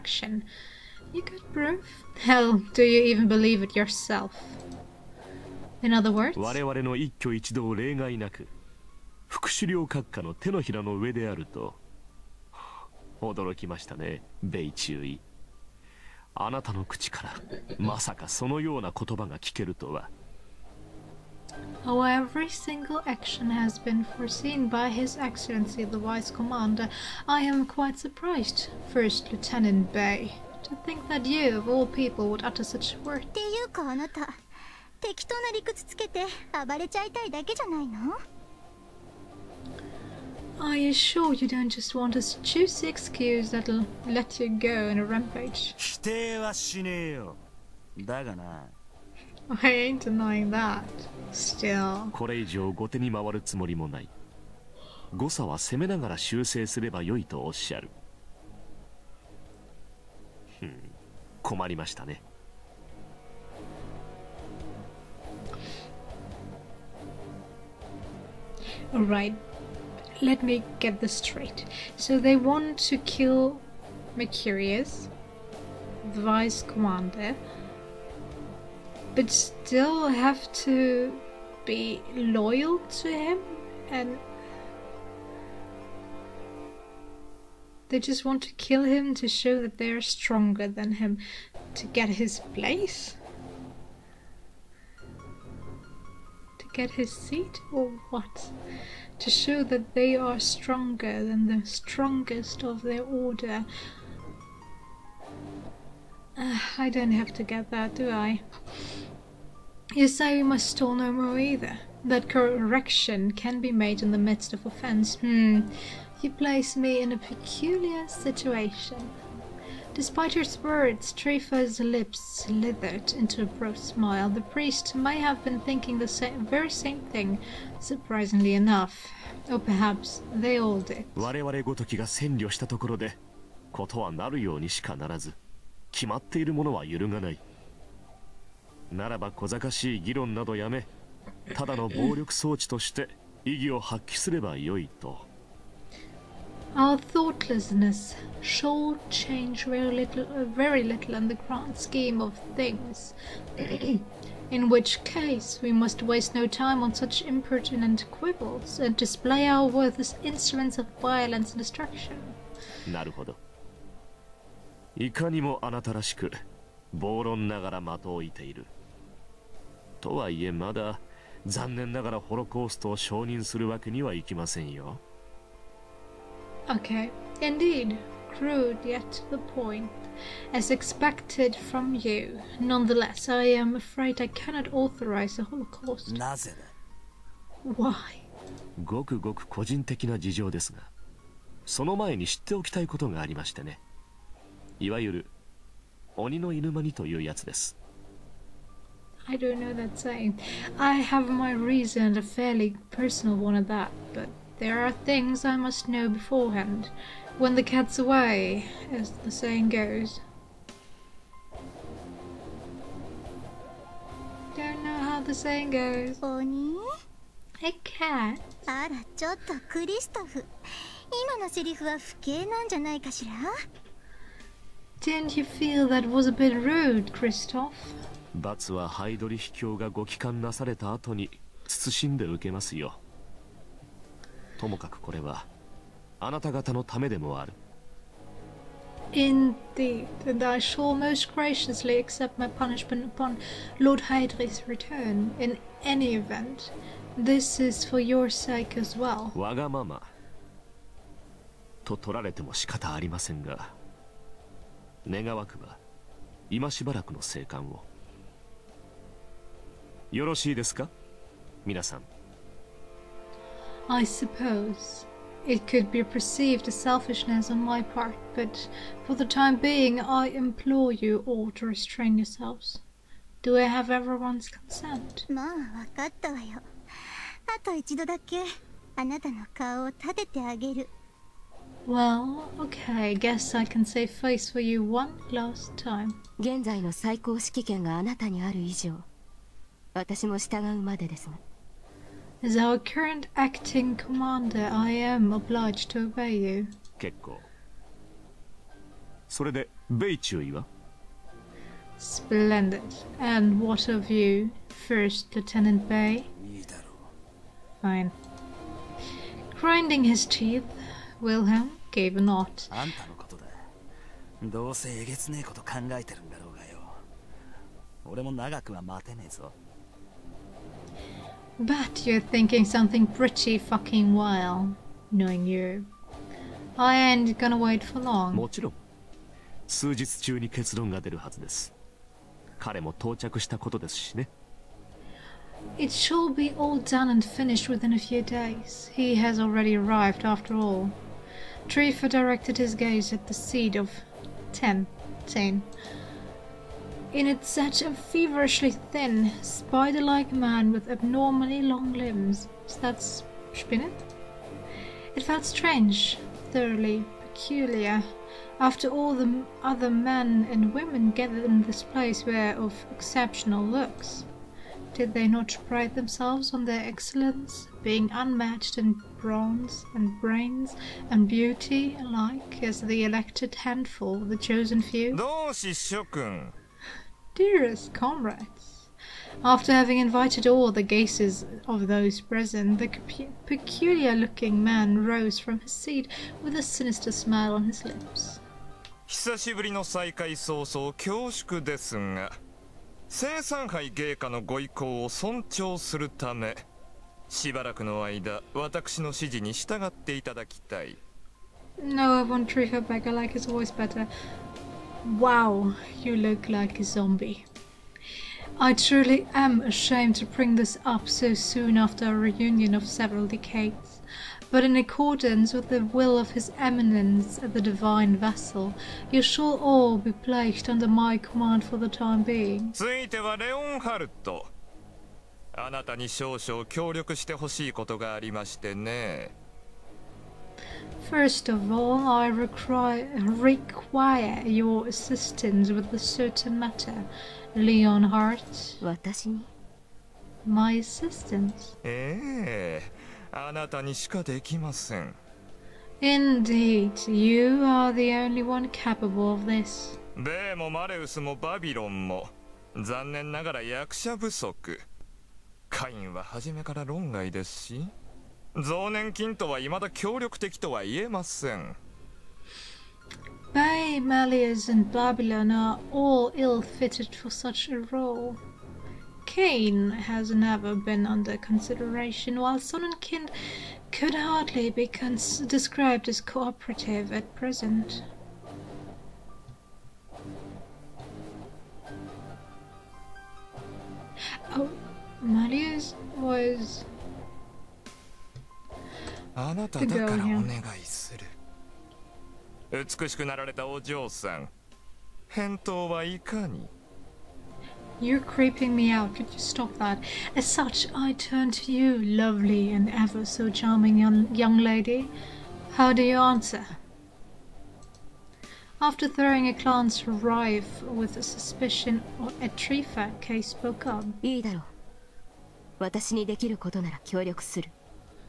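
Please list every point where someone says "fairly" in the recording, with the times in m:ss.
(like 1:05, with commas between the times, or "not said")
3:22.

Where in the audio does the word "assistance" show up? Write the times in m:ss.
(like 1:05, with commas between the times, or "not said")
7:14, 7:20.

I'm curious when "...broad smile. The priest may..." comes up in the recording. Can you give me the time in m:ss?
2:03.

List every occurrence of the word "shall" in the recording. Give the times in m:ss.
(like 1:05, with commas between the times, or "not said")
2:28, 4:00, 5:35, 6:59.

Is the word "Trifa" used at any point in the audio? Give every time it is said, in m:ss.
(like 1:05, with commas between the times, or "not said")
2:01, 5:41, 8:32.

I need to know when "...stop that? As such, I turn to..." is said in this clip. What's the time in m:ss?
8:19.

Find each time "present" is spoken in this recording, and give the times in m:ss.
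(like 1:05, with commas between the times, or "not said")
6:22, 7:57.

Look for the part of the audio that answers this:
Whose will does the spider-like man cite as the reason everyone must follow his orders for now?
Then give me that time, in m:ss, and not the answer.
6:56.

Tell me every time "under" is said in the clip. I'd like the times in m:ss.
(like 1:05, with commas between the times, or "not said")
7:00, 7:51.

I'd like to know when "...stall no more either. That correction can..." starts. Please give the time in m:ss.
1:50.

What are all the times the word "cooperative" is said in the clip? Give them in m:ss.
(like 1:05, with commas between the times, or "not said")
7:56.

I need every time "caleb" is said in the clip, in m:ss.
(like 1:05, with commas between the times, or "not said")
not said.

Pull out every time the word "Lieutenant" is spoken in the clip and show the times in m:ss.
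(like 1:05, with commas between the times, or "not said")
0:29, 5:05.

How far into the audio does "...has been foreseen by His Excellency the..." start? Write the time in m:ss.
0:23.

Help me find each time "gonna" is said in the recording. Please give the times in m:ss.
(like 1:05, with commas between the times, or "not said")
5:27.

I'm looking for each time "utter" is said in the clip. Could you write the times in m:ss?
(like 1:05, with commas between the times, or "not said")
0:32.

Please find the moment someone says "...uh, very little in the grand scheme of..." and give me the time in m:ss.
2:30.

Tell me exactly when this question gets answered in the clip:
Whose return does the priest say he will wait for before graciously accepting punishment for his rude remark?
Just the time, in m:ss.
4:03.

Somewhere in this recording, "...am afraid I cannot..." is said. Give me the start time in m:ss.
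3:03.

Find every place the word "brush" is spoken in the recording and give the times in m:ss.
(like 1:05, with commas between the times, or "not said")
not said.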